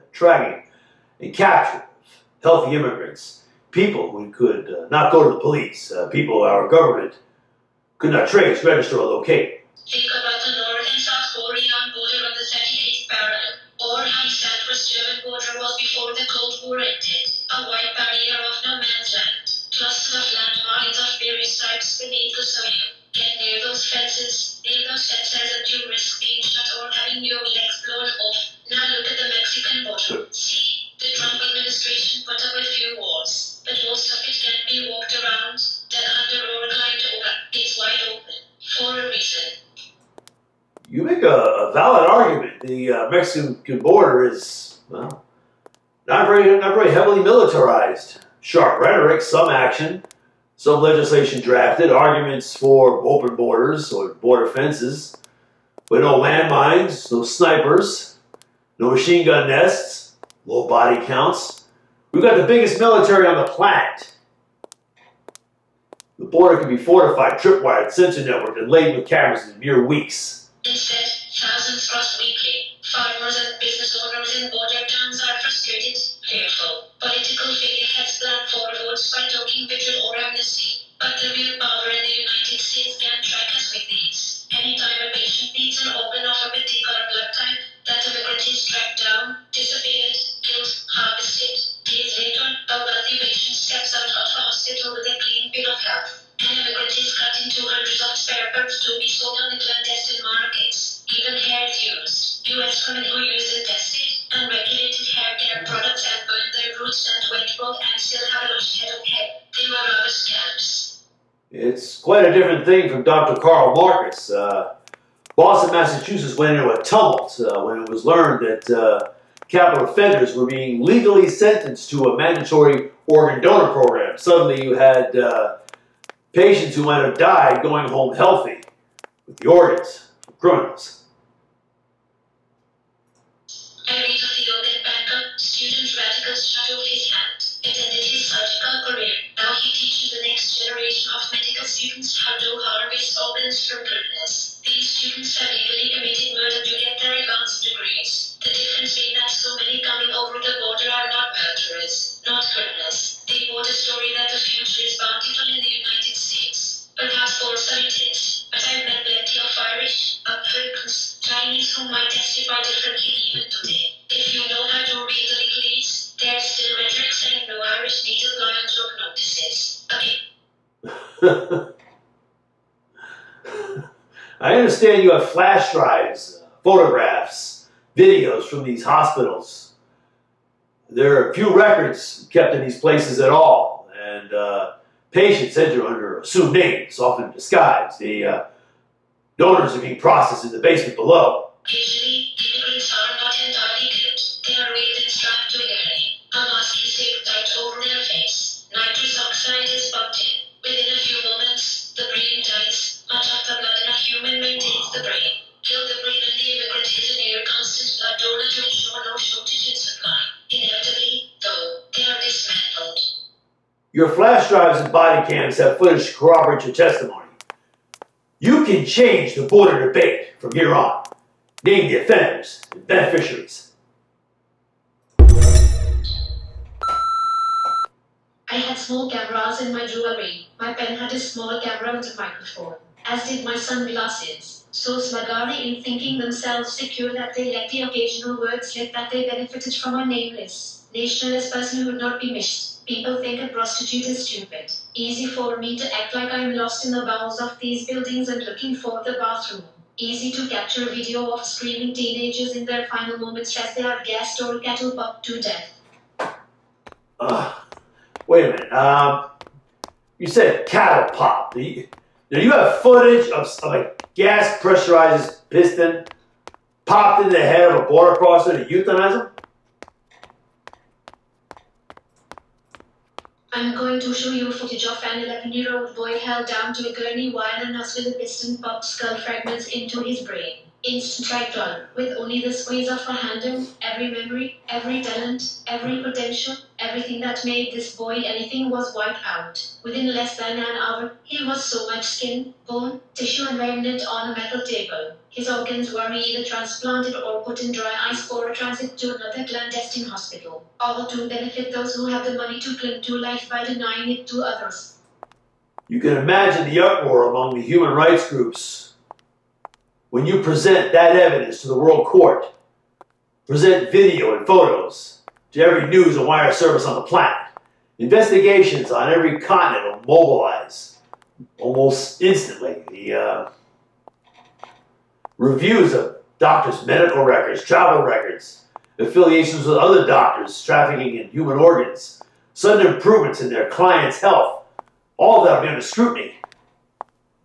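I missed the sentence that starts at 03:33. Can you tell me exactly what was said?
Your flash drives and body cams have footage to corroborate your testimony.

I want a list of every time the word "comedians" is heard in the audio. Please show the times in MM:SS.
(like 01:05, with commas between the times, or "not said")
not said.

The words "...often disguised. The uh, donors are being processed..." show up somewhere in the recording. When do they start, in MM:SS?
03:06.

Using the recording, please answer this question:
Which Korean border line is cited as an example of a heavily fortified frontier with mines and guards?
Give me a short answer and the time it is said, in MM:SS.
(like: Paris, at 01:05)
38th parallel, at 00:12.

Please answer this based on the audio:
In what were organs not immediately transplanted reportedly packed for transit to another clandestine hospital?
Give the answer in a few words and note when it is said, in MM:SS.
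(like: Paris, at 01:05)
Dry ice, at 04:57.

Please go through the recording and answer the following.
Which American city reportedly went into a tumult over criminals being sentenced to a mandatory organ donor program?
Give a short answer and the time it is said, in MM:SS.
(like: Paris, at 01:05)
Boston, Massachusetts, at 01:55.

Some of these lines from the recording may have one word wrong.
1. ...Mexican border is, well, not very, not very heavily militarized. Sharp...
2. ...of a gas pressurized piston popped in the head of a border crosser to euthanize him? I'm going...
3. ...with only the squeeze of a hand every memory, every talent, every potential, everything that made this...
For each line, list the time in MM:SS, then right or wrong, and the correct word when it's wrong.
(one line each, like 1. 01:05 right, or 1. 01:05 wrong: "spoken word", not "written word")
1. 00:43 right
2. 04:23 right
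3. 04:41 right.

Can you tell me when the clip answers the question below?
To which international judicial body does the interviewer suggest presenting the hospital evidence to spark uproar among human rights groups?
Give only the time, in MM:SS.
05:11.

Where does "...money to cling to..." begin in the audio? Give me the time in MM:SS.
05:02.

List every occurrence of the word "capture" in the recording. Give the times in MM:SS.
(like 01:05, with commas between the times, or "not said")
00:01, 04:10.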